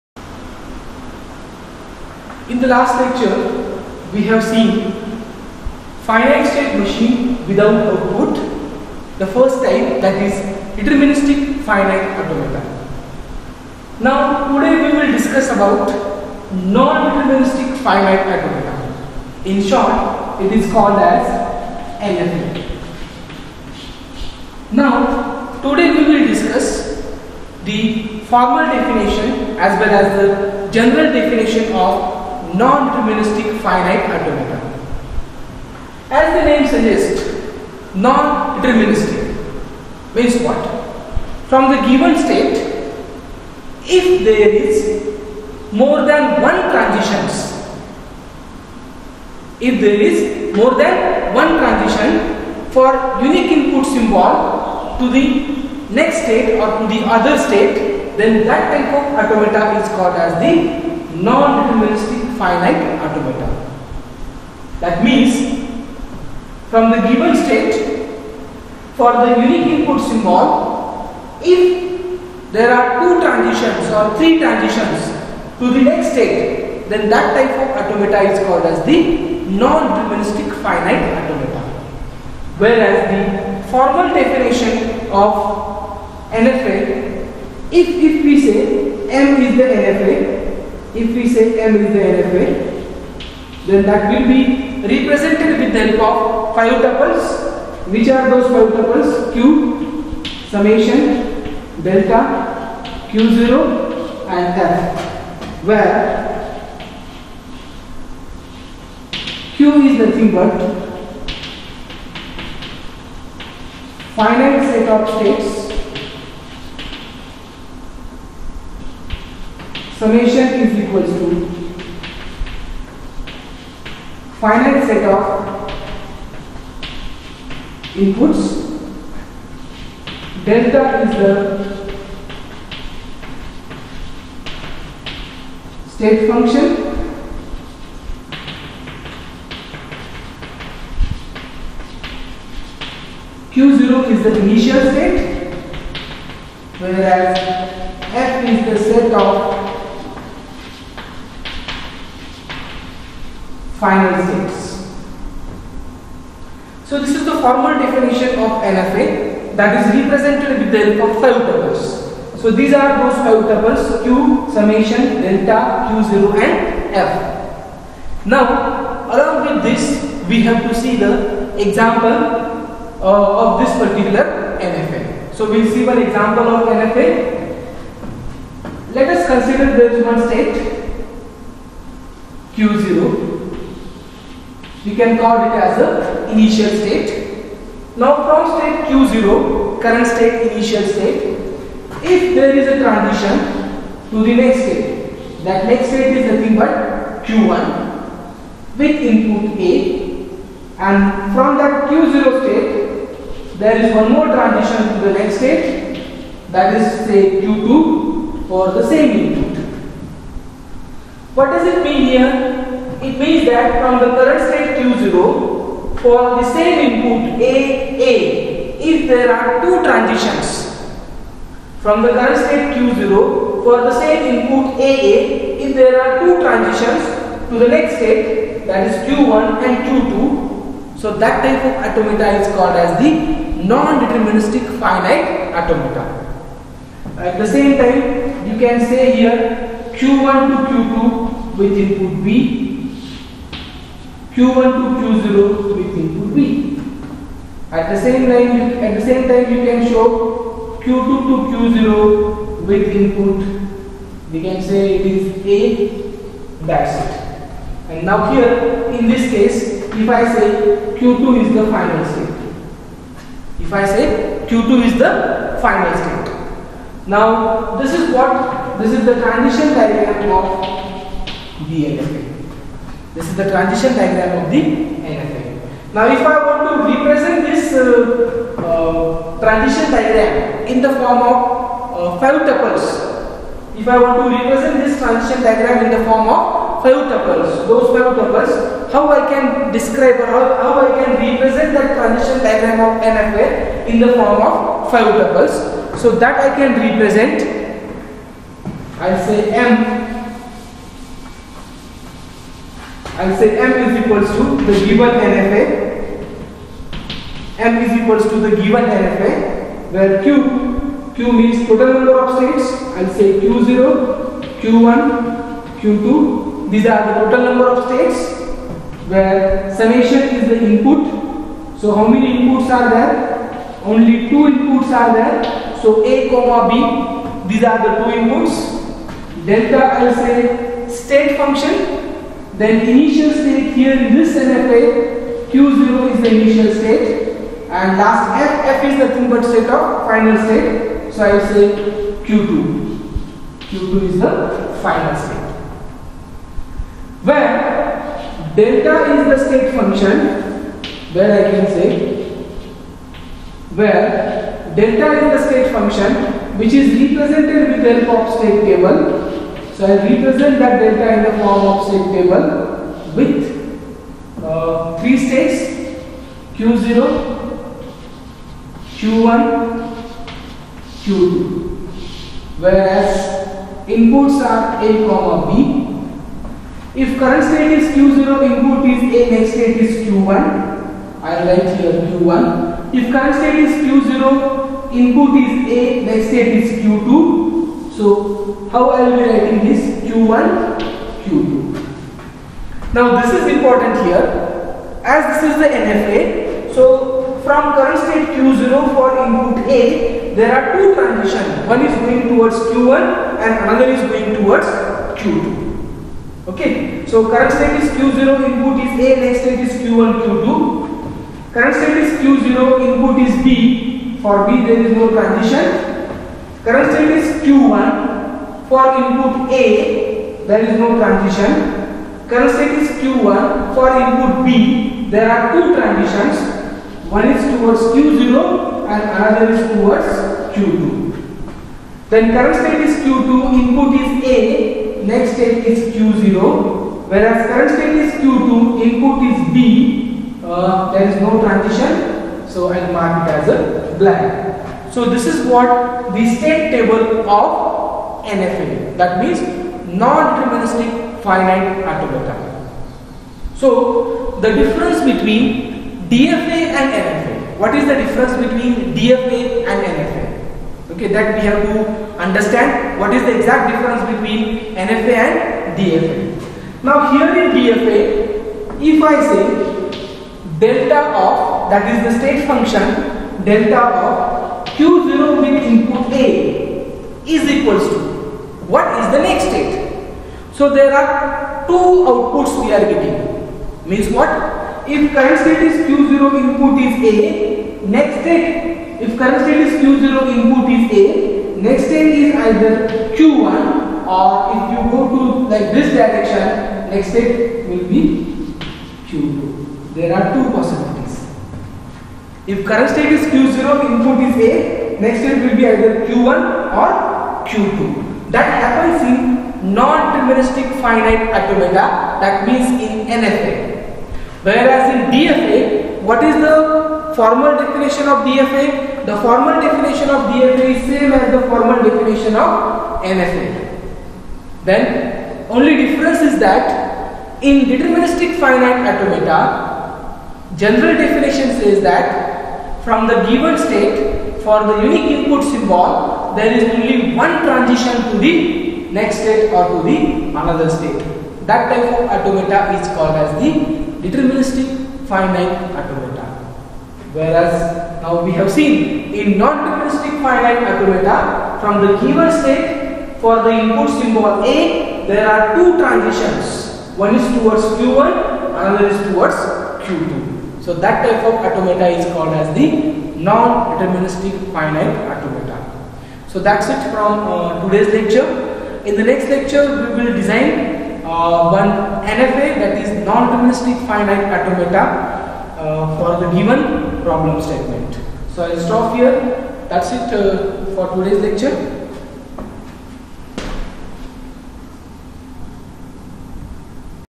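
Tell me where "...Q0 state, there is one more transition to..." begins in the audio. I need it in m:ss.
3:21.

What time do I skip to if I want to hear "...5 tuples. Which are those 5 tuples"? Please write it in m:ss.
1:36.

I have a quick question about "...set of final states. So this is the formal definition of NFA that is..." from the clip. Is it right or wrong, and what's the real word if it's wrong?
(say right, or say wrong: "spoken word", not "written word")
right.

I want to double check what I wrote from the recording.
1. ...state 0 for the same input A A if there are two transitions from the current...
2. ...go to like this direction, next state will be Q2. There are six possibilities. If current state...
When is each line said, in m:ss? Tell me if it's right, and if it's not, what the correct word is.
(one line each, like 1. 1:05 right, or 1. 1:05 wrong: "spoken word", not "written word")
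1. 3:34 right
2. 8:14 wrong: "two", not "six".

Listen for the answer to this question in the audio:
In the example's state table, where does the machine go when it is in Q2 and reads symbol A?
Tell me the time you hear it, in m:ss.
7:15.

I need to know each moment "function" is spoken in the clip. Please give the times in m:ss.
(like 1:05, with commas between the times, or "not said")
2:16, 5:31, 5:49, 5:55, 7:52.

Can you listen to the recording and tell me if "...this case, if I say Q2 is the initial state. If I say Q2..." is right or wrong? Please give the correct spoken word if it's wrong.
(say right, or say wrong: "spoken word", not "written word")
wrong: "final", not "initial".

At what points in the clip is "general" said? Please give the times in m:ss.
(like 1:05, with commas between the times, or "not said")
0:30, 8:50.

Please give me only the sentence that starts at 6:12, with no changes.
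Whereas inputs are A comma B.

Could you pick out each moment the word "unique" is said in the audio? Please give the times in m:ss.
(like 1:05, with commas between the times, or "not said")
0:53, 1:09, 8:54.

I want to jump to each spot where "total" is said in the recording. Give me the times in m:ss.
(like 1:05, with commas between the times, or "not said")
5:11, 5:17.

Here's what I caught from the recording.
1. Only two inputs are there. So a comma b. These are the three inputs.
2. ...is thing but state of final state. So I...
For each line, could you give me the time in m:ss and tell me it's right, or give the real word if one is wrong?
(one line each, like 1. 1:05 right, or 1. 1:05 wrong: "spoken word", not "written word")
1. 5:23 wrong: "two", not "three"
2. 5:39 right.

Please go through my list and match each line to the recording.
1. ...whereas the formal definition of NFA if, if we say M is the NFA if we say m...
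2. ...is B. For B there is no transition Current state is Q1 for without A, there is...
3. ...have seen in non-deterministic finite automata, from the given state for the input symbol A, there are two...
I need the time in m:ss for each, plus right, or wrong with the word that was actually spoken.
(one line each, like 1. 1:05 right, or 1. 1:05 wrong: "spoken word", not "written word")
1. 1:22 right
2. 6:53 wrong: "input", not "without"
3. 9:08 right.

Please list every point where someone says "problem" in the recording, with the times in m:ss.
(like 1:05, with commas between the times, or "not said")
9:37.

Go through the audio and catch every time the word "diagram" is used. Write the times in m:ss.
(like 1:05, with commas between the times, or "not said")
4:29, 4:33, 4:39, 4:45, 4:52.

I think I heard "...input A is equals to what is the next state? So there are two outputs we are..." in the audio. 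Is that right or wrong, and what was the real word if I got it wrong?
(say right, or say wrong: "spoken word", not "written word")
right.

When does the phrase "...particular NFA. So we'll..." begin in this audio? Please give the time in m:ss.
2:53.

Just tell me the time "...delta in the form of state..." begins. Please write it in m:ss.
6:00.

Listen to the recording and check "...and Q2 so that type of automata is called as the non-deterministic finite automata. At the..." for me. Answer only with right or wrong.
right.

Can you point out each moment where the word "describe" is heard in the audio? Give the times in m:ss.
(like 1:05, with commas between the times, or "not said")
4:49.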